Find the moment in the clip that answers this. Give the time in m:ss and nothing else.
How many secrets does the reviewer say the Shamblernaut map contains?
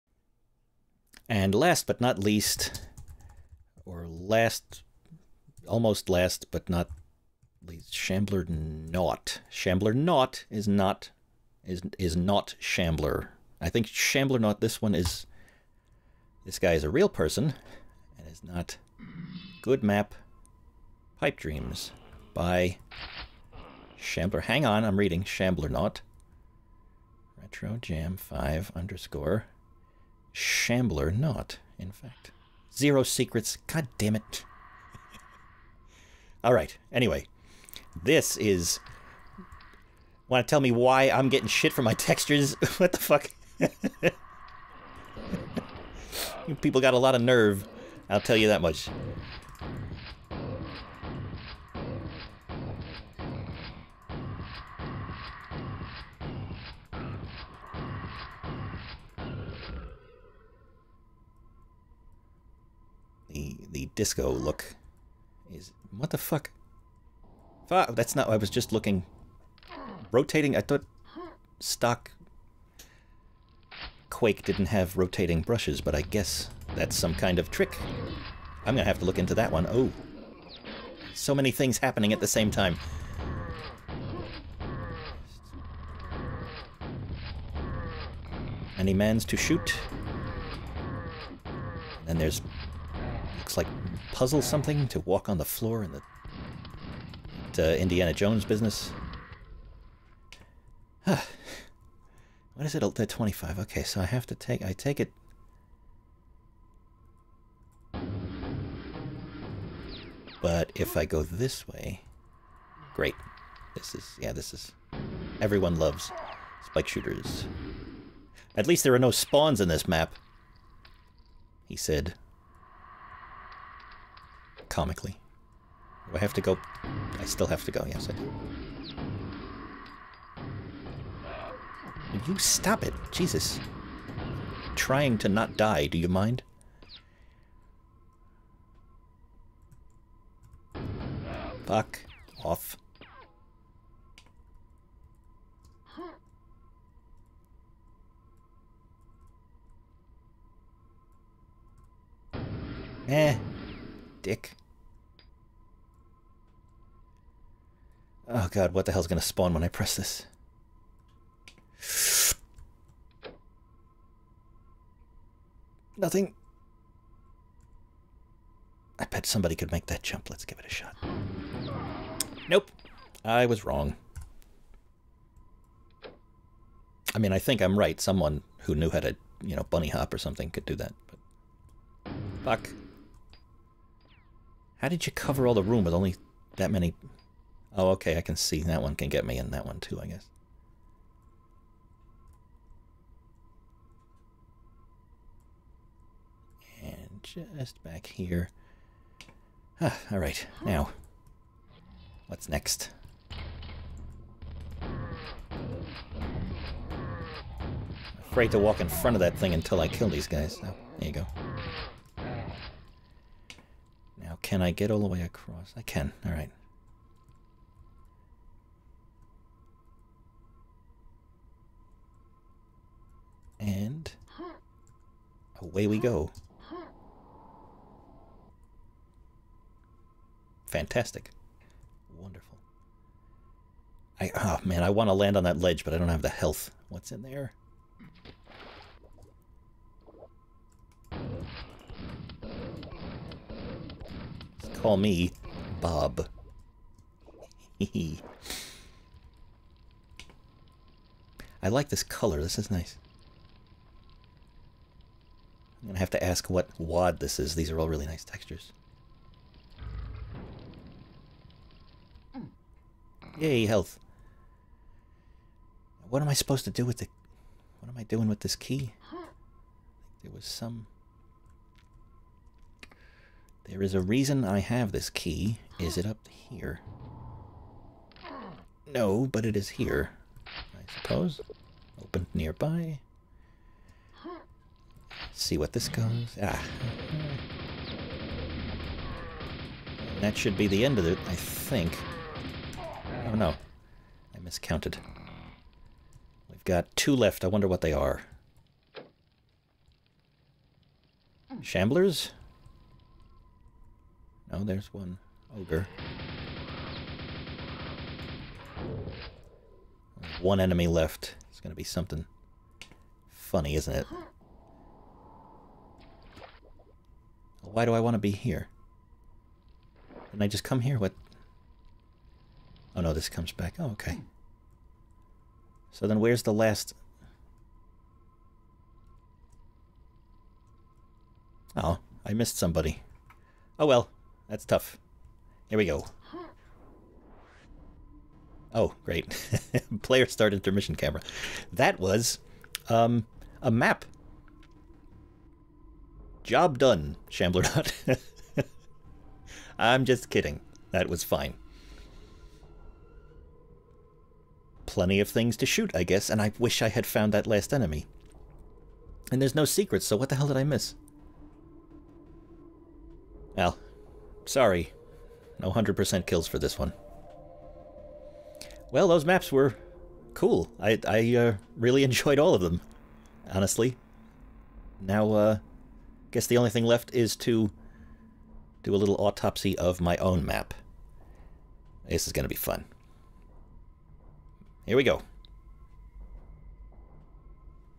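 0:32.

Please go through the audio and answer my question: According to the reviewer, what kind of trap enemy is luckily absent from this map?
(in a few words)
spawns.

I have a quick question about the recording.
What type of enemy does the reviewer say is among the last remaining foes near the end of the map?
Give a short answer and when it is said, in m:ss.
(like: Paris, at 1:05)
ogre, at 5:04.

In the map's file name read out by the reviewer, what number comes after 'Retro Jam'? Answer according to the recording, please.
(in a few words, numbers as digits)
5.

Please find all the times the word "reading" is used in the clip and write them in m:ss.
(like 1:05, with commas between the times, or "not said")
0:24.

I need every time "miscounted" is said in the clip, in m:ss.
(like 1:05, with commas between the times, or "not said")
4:54.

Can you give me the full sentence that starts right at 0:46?
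People got a lot of nerve.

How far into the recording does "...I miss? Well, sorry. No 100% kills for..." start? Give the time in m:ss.
6:00.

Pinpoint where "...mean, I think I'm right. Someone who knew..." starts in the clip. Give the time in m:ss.
2:57.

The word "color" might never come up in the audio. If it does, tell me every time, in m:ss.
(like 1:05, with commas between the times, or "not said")
4:12.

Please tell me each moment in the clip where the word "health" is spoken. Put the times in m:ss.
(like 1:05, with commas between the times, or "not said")
3:56, 4:23.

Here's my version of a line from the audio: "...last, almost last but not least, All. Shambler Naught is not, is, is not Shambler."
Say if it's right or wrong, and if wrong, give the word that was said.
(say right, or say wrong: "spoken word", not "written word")
wrong: "Shamblernaut", not "All".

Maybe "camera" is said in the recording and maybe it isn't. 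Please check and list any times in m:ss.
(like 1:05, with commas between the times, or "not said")
5:40.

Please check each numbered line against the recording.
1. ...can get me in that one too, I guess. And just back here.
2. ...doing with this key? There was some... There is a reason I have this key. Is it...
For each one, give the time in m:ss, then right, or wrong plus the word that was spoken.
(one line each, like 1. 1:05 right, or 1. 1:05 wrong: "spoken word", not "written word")
1. 3:08 right
2. 4:28 right.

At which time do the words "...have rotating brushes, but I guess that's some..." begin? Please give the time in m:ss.
1:14.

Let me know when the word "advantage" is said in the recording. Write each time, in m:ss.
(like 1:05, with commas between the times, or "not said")
not said.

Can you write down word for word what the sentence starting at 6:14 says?
Now, uh, Guess the only thing left is to do a little autopsy of my own map.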